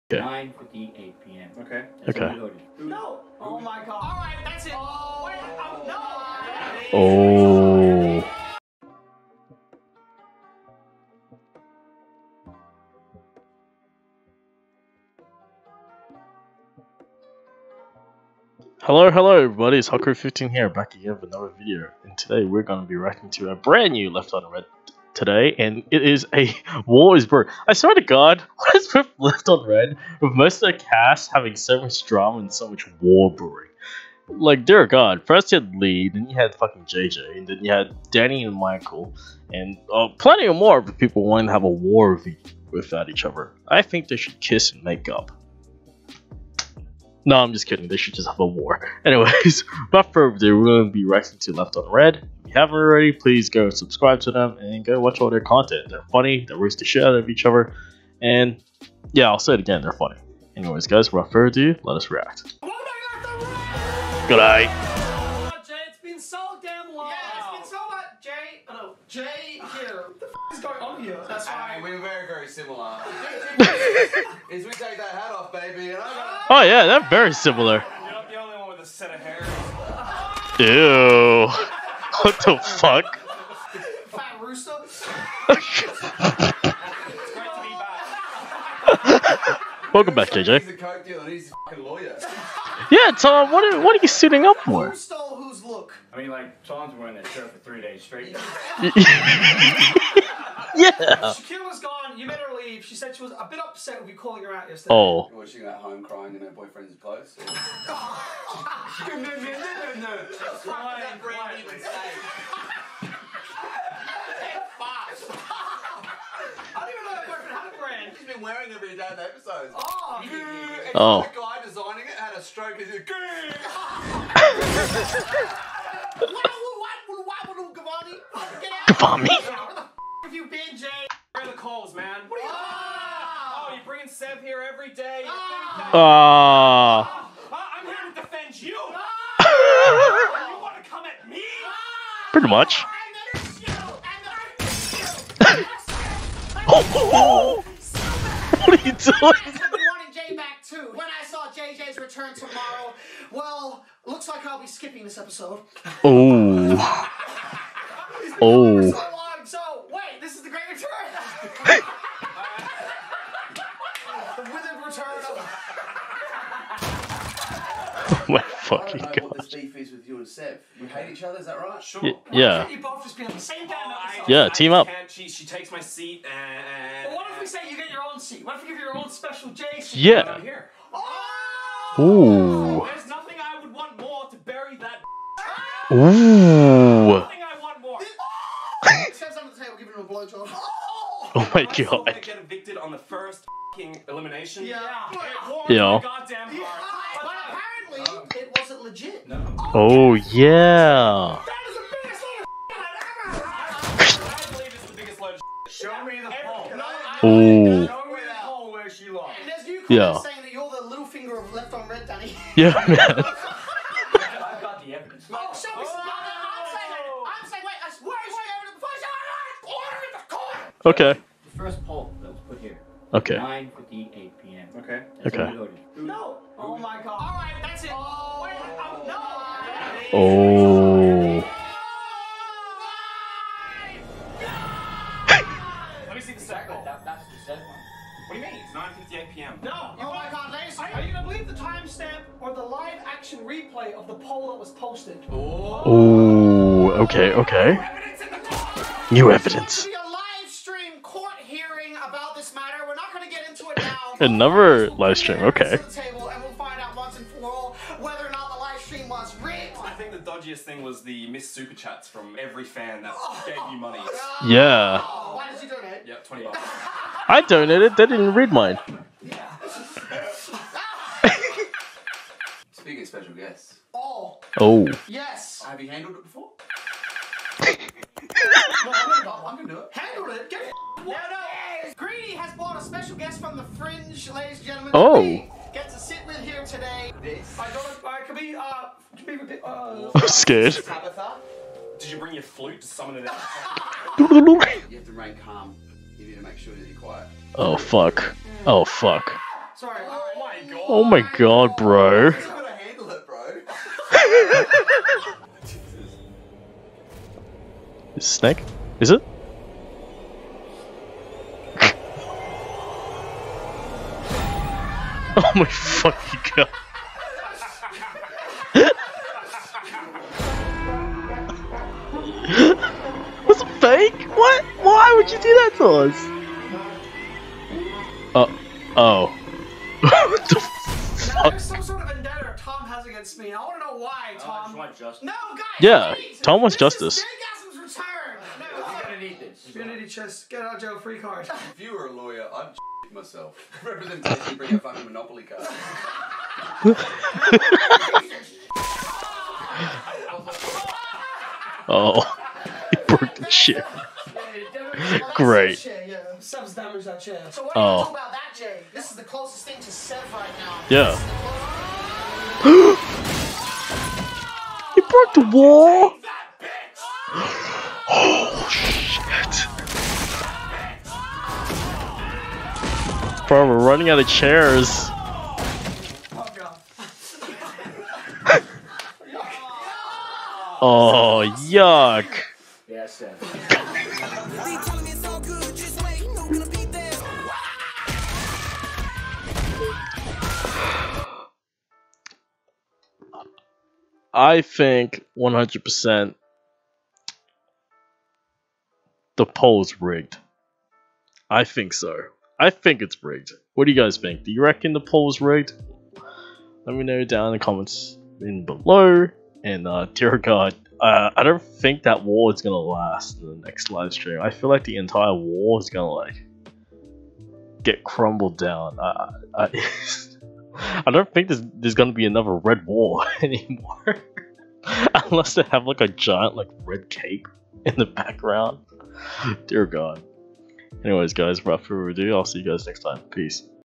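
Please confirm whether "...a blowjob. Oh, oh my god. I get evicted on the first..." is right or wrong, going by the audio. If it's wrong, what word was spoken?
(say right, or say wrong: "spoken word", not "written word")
right.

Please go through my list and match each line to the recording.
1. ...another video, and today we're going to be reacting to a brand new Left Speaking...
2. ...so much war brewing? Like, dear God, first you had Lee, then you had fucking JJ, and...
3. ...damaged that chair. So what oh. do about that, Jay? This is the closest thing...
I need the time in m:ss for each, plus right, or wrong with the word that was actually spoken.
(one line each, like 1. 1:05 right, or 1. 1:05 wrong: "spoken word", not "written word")
1. 0:21 wrong: "Out", not "Speaking"
2. 0:32 right
3. 5:56 right.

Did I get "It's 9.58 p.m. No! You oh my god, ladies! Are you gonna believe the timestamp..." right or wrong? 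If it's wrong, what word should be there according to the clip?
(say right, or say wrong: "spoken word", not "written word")
right.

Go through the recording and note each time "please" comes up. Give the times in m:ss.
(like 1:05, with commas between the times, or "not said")
0:53, 5:36.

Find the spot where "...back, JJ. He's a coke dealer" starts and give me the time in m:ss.
1:30.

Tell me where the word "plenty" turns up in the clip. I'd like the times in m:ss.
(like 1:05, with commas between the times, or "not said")
0:40.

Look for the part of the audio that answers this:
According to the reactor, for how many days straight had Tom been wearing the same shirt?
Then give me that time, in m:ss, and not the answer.
1:37.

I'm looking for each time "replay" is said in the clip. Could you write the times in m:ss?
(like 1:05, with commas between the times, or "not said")
4:03.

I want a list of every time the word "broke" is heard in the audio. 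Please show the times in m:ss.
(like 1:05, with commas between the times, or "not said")
5:53, 6:05.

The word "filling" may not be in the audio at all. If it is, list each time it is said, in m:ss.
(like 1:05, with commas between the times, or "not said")
not said.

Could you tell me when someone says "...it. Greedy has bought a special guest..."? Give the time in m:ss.
4:40.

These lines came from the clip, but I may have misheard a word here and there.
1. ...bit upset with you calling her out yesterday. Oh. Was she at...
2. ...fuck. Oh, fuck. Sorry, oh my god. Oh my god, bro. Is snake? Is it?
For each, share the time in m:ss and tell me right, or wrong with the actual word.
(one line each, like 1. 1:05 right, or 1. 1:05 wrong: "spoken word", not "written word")
1. 1:43 right
2. 4:57 right.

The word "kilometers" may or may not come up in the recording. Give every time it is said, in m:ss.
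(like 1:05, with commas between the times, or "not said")
not said.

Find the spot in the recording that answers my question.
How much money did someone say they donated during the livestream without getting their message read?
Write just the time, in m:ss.
4:26.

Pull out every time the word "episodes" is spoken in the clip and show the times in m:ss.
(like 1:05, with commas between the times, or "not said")
1:59, 2:35.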